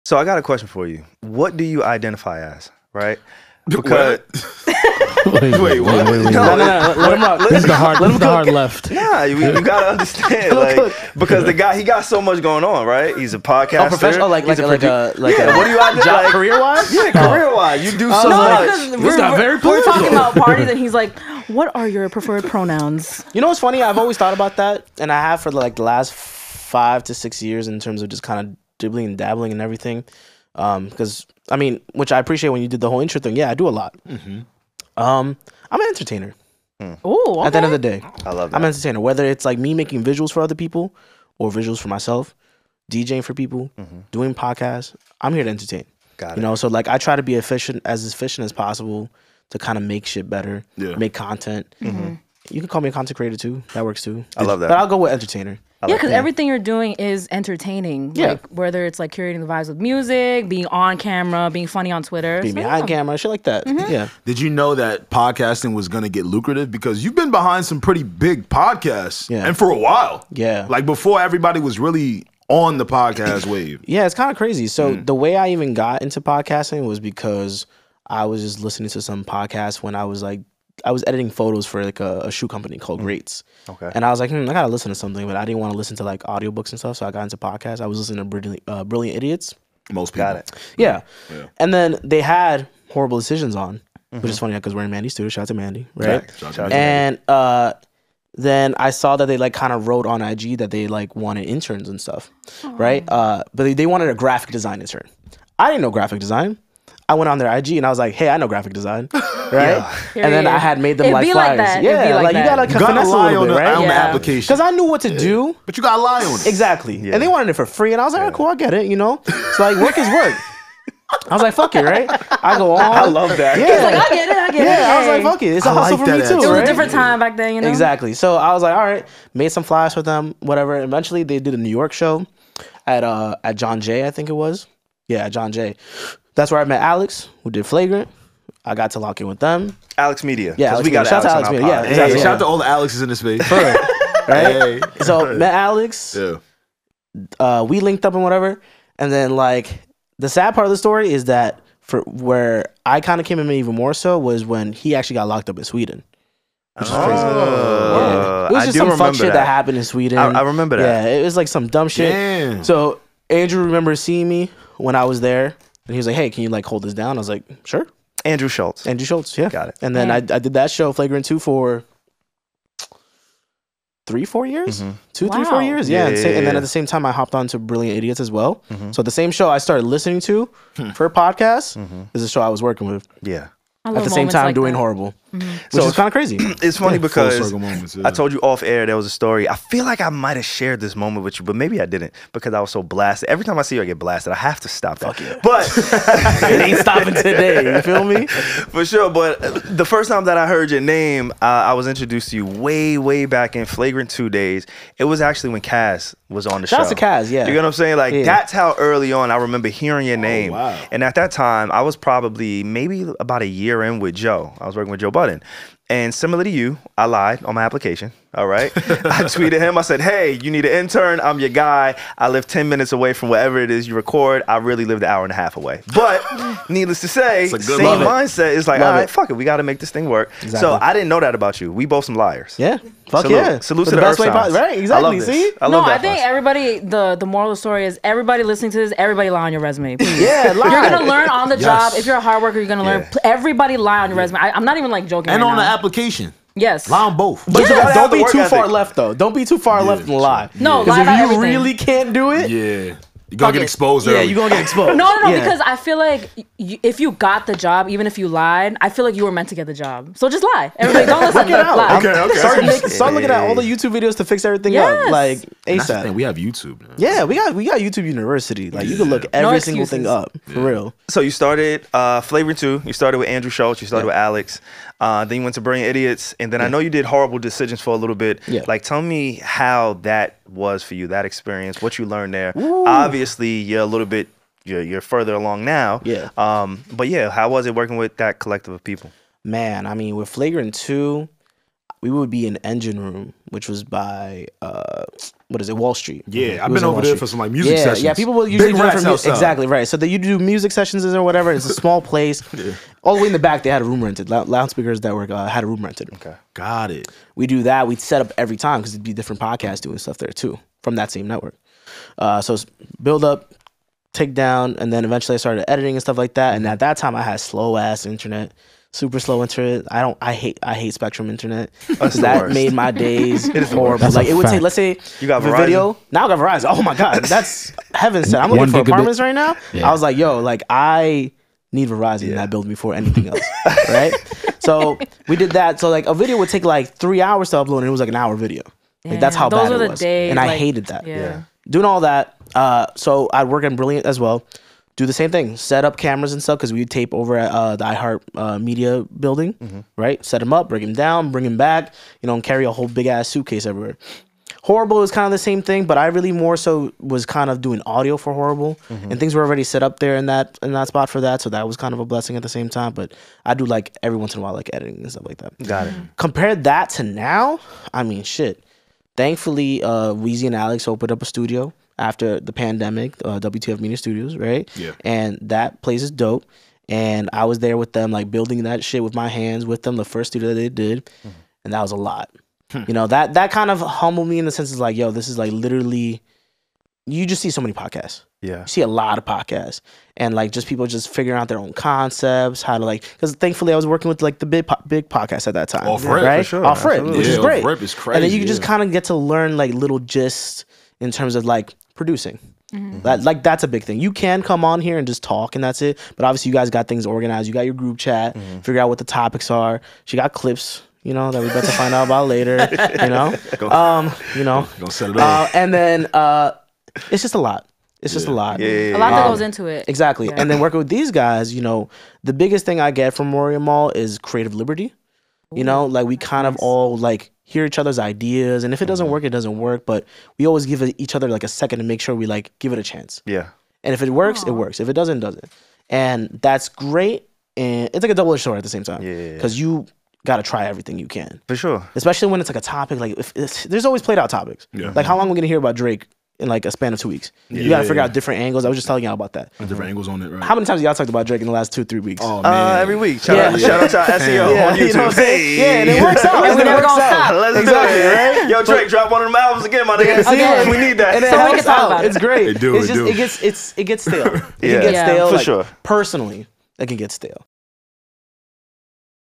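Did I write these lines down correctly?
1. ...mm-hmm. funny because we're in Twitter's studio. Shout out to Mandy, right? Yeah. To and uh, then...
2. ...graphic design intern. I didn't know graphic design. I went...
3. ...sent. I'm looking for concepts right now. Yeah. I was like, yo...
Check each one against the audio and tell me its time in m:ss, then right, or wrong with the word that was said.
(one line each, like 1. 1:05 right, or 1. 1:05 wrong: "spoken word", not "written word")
1. 1:34 wrong: "Mandy", not "Twitter"
2. 1:44 right
3. 5:28 wrong: "apartments", not "concepts".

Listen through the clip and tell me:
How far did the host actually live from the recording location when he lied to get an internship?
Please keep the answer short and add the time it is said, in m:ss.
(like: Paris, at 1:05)
an hour and a half, at 3:45.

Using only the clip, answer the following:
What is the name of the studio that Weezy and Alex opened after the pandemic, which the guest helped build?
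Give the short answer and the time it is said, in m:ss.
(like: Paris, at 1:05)
WTF Media Studios, at 6:13.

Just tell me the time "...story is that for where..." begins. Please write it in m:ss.
2:30.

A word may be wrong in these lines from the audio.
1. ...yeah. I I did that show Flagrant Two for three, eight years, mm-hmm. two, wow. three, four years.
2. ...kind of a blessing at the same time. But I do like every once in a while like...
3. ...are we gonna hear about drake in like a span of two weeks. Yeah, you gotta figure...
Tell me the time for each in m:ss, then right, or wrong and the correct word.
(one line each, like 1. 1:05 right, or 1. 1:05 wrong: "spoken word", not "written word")
1. 2:50 wrong: "four", not "eight"
2. 6:01 right
3. 7:25 right.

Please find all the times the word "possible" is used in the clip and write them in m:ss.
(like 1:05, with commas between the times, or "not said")
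0:48, 3:54.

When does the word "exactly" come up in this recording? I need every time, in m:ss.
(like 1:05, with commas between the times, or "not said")
1:56, 2:07, 2:21, 3:50, 3:54, 4:59, 6:59, 7:37.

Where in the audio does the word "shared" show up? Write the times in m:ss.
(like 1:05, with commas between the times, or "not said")
3:10.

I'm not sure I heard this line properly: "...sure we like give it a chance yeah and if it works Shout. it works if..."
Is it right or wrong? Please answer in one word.
wrong.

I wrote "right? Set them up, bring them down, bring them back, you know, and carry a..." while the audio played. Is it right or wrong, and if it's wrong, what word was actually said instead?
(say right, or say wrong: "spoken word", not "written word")
right.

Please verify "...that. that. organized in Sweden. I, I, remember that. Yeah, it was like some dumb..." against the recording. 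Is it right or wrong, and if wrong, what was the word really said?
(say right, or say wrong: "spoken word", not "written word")
wrong: "happened", not "organized".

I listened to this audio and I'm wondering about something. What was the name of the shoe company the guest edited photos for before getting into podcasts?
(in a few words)
Greats.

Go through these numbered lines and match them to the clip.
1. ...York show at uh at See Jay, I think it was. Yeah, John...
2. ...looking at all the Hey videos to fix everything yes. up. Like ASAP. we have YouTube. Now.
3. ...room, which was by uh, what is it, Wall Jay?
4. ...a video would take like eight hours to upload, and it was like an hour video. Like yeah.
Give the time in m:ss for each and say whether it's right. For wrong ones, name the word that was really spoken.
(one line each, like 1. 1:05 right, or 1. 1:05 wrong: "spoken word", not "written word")
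1. 2:11 wrong: "John", not "See"
2. 4:23 wrong: "YouTube", not "Hey"
3. 4:52 wrong: "Street", not "Jay"
4. 5:36 wrong: "three", not "eight".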